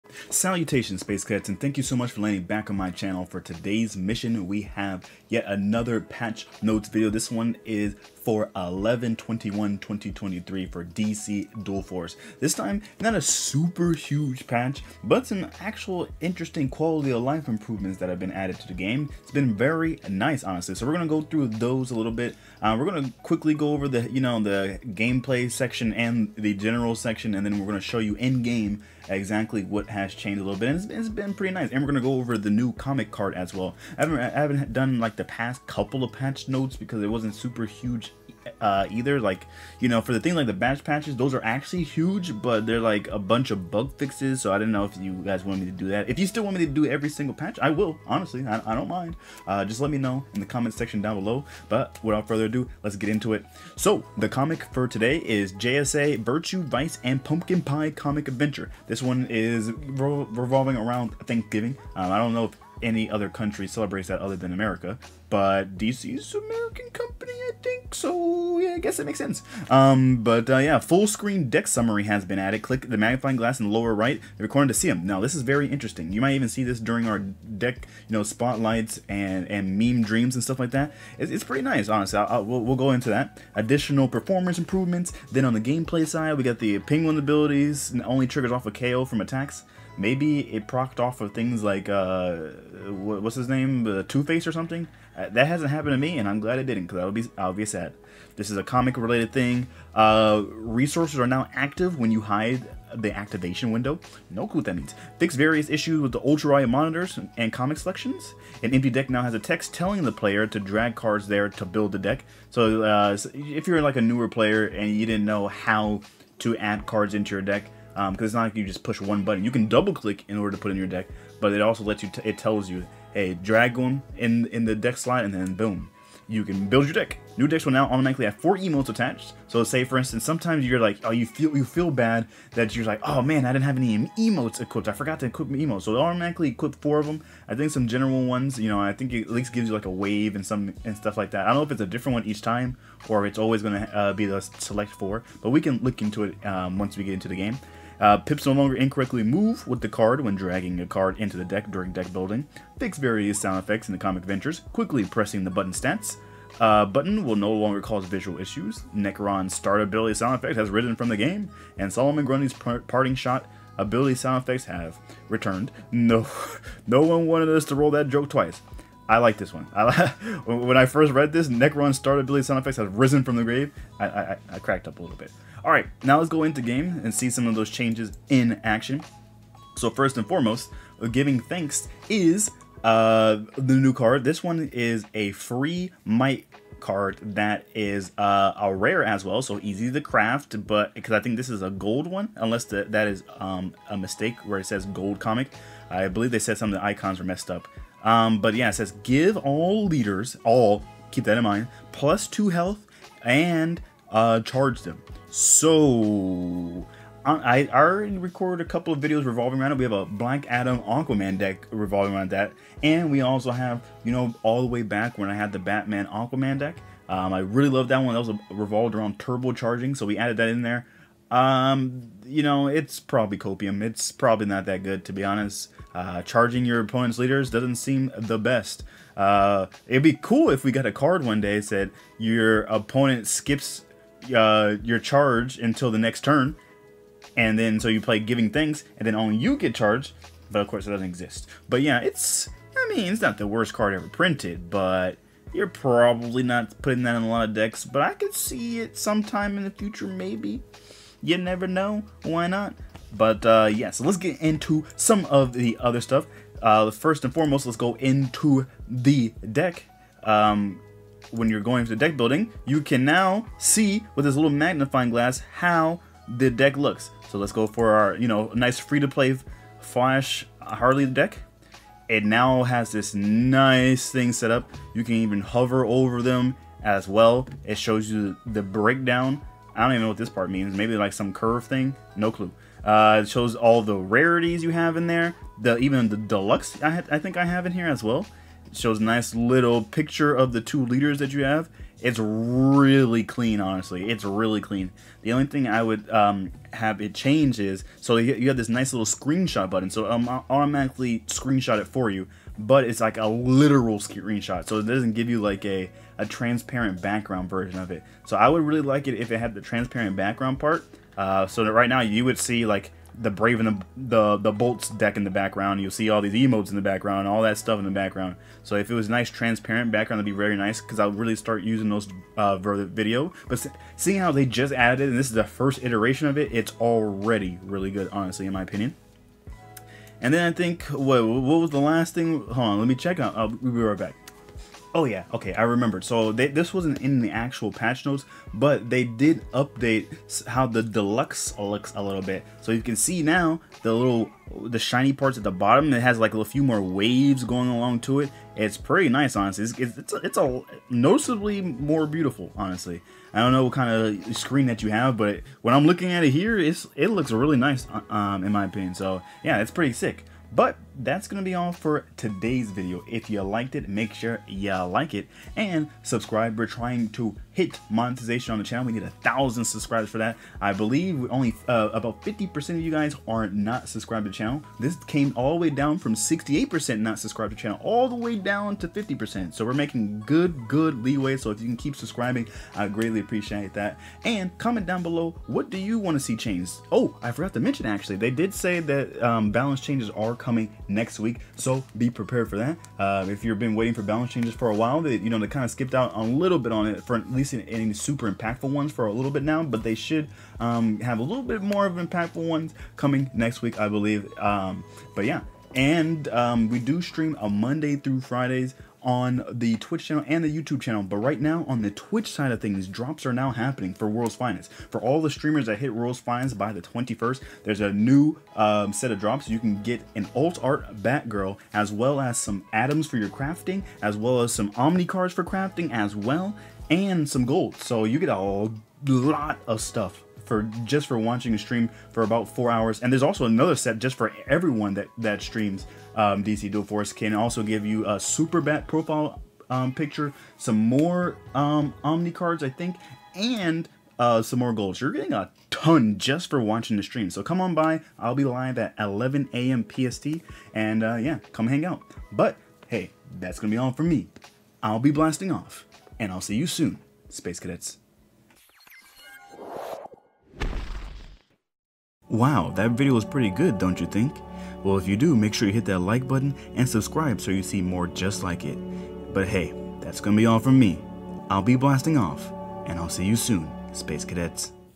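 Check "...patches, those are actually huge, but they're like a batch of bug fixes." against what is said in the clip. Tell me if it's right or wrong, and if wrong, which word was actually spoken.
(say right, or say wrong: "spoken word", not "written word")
wrong: "bunch", not "batch".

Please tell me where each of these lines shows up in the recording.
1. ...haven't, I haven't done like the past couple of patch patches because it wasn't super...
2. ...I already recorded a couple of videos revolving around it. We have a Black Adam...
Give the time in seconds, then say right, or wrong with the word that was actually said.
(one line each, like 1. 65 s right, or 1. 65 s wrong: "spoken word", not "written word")
1. 34 s wrong: "notes", not "patches"
2. 207 s right.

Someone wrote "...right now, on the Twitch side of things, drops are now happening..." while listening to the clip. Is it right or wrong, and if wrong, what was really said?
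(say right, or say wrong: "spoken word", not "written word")
right.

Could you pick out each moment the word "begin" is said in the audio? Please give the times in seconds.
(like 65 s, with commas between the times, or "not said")
not said.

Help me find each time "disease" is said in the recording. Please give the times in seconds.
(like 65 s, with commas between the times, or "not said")
not said.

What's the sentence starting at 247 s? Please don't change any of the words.
But I could see it sometime in the future, maybe.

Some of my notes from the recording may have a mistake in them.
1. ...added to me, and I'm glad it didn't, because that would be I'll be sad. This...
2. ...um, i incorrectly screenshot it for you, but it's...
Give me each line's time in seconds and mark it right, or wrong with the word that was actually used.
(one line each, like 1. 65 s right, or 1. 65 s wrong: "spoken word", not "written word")
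1. 95 s wrong: "happened", not "added"
2. 300 s wrong: "automatically", not "incorrectly".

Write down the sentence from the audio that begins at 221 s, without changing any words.
Um, you know, it's probably copium.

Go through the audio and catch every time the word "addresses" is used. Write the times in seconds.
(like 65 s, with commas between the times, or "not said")
not said.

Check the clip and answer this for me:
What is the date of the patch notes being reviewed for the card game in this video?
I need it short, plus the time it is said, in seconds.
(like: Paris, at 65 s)
11-21-2023, at 8 s.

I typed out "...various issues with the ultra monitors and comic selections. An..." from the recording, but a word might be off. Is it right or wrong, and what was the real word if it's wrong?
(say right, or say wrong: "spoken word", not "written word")
right.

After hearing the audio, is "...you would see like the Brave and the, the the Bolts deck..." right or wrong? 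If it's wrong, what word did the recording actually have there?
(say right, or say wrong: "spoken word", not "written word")
right.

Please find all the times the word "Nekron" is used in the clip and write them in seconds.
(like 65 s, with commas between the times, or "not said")
158 s, 171 s.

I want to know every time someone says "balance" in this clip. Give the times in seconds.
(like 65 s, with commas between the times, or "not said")
389 s, 394 s.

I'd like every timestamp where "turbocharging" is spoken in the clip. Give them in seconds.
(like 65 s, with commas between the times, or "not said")
219 s.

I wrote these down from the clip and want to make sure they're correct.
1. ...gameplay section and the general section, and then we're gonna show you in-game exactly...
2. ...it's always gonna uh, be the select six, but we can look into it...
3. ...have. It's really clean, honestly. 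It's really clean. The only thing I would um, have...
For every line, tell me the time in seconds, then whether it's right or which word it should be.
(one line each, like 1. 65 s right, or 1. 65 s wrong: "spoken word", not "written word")
1. 24 s right
2. 143 s wrong: "four", not "six"
3. 291 s right.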